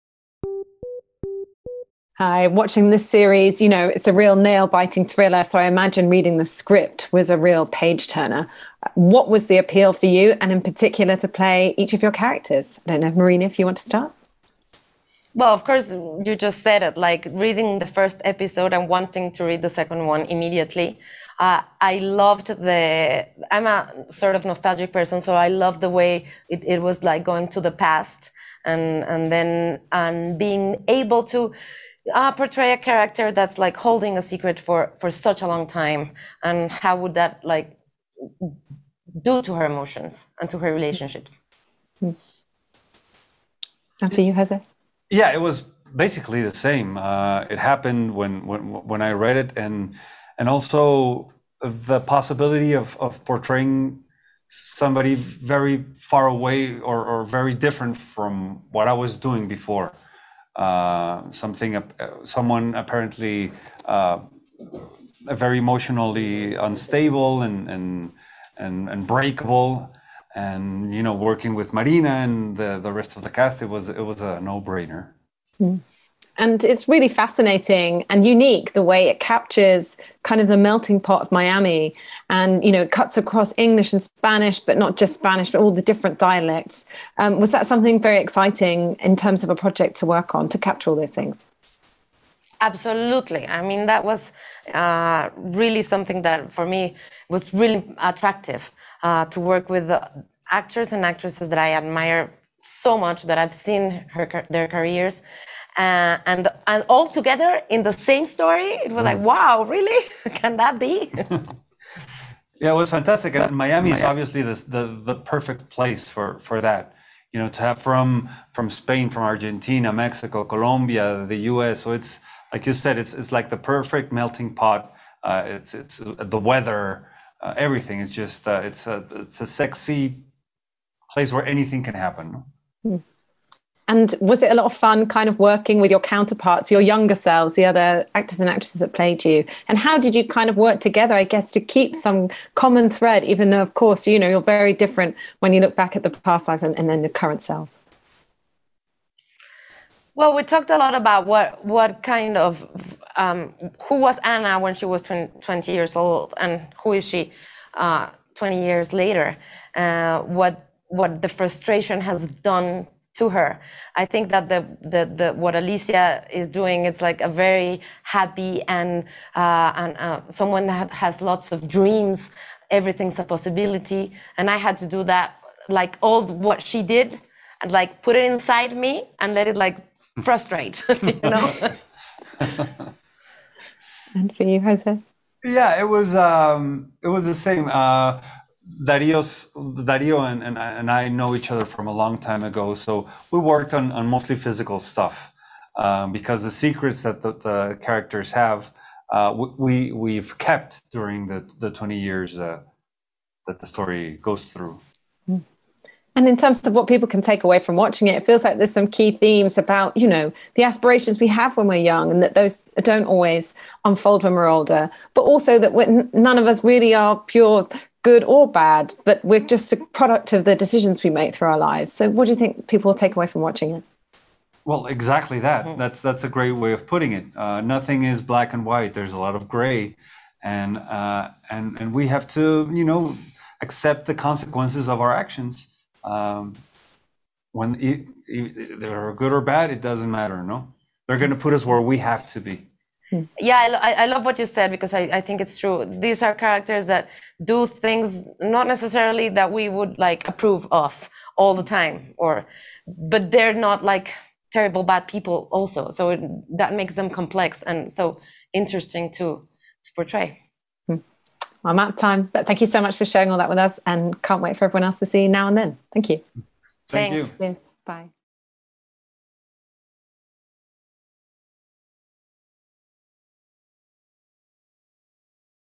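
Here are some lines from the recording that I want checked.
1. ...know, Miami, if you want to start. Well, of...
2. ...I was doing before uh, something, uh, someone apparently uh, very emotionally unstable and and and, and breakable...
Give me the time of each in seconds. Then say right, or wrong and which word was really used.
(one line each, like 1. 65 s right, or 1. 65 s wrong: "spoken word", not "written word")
1. 13 s wrong: "Marina", not "Miami"
2. 58 s right.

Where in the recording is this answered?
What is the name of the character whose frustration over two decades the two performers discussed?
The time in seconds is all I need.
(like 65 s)
154 s.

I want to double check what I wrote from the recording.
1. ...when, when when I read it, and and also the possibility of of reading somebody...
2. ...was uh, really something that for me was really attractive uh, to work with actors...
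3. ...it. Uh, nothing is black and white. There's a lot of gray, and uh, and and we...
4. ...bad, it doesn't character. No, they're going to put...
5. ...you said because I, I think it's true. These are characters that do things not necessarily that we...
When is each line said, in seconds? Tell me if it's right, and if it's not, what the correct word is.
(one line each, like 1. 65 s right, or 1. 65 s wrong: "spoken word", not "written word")
1. 48 s wrong: "portraying", not "reading"
2. 94 s right
3. 227 s right
4. 239 s wrong: "matter", not "character"
5. 244 s right.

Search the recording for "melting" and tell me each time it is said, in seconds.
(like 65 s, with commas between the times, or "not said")
80 s, 124 s.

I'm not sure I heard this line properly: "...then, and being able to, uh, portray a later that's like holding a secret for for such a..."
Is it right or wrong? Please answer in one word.
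wrong.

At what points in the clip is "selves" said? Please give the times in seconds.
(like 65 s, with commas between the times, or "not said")
137 s, 147 s.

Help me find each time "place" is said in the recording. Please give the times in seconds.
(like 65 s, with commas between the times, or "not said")
115 s, 131 s.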